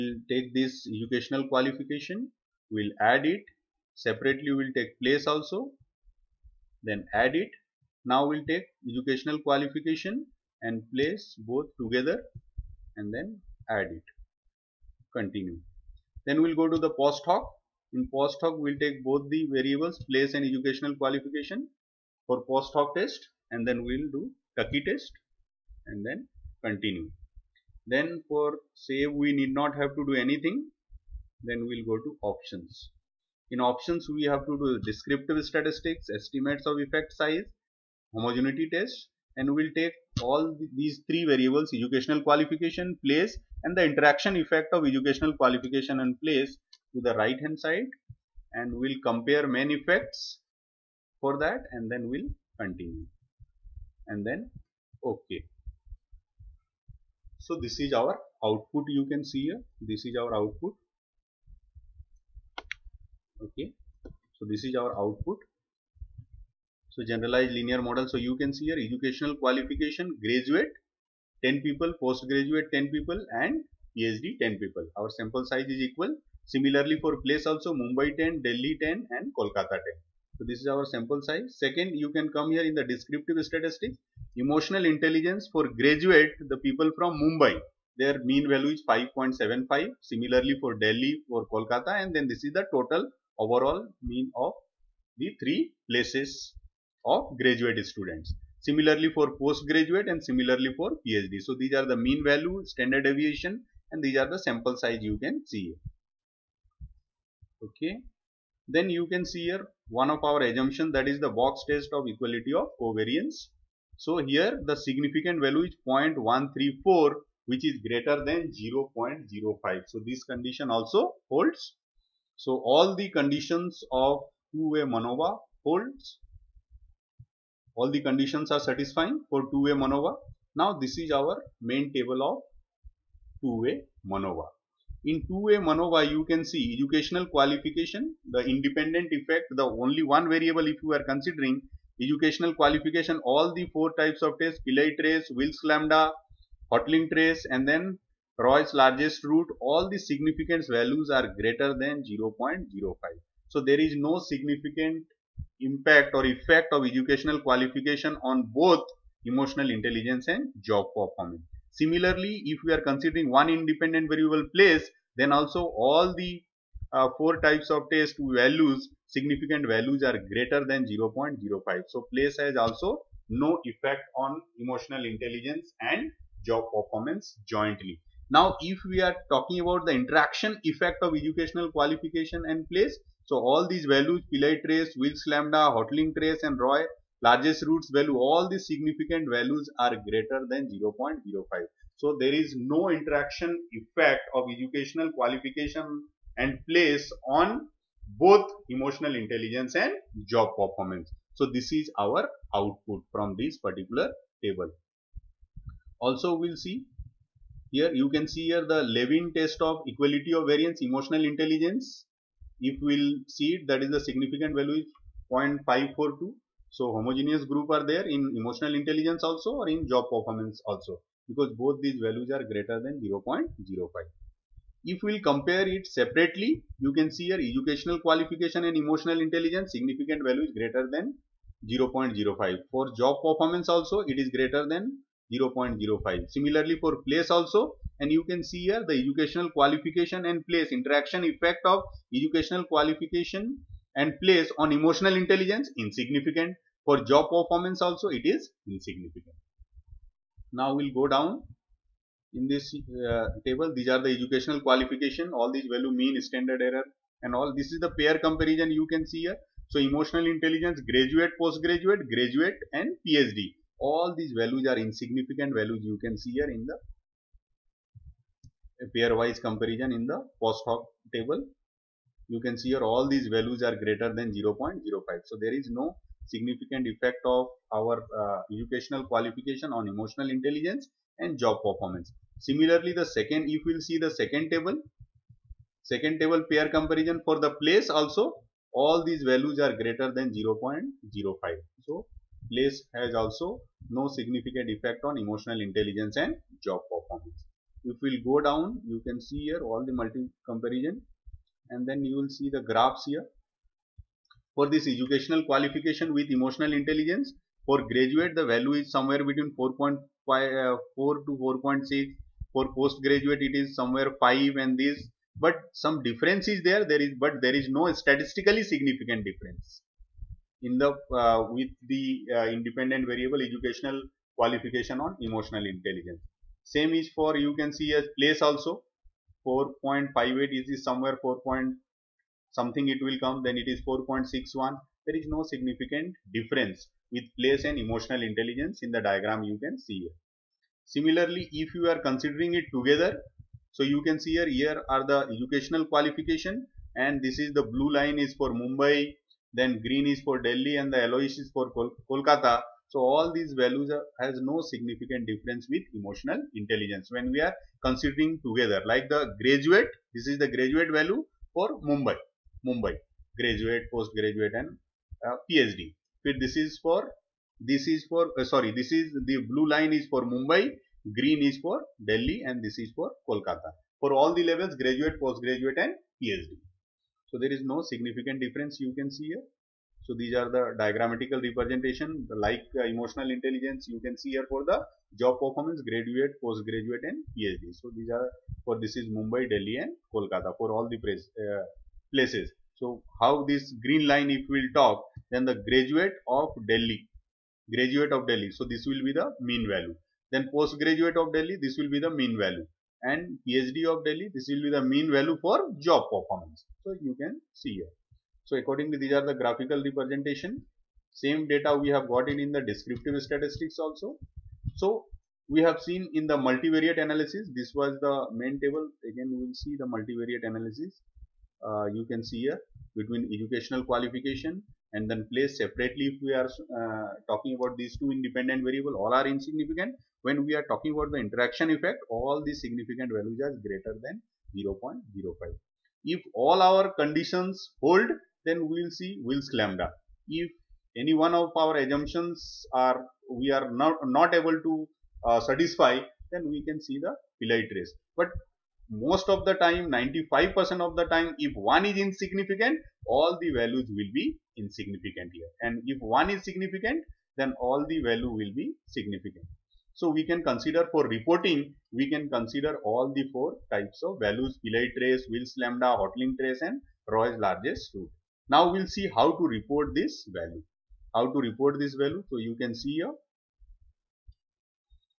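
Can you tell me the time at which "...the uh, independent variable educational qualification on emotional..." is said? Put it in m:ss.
5:21.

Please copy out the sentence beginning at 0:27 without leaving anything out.
Then for save, we need not have to do anything.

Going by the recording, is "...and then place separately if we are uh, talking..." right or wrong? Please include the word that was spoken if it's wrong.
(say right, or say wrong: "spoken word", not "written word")
right.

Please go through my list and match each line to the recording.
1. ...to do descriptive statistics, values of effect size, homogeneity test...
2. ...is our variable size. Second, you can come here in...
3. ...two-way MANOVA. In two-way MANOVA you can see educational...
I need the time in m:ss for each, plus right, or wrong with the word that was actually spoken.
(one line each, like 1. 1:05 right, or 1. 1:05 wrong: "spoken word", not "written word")
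1. 0:34 wrong: "estimates", not "values"
2. 1:20 wrong: "sample", not "variable"
3. 2:13 right.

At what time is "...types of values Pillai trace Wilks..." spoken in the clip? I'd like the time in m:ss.
7:43.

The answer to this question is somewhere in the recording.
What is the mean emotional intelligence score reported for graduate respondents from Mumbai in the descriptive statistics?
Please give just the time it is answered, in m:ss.
1:28.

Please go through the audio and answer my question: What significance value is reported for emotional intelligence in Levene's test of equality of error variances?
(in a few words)
0.542.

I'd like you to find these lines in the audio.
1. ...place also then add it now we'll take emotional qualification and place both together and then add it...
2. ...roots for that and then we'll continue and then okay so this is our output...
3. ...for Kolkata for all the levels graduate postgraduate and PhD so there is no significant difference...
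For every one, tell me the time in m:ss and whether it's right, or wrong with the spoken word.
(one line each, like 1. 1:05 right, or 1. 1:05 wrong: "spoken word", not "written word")
1. 0:05 wrong: "educational", not "emotional"
2. 0:49 wrong: "effects", not "roots"
3. 6:12 right.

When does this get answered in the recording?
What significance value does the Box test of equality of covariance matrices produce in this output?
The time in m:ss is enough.
1:55.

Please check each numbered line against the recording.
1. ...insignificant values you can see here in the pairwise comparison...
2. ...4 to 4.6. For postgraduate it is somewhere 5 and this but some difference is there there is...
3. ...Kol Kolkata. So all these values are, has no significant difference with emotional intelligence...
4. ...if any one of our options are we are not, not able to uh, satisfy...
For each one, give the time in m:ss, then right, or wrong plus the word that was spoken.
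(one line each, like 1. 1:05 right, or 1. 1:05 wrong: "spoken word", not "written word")
1. 4:24 right
2. 5:10 right
3. 5:51 right
4. 7:20 wrong: "assumptions", not "options".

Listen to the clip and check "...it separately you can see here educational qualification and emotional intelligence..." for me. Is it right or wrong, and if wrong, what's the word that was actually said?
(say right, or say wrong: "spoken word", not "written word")
right.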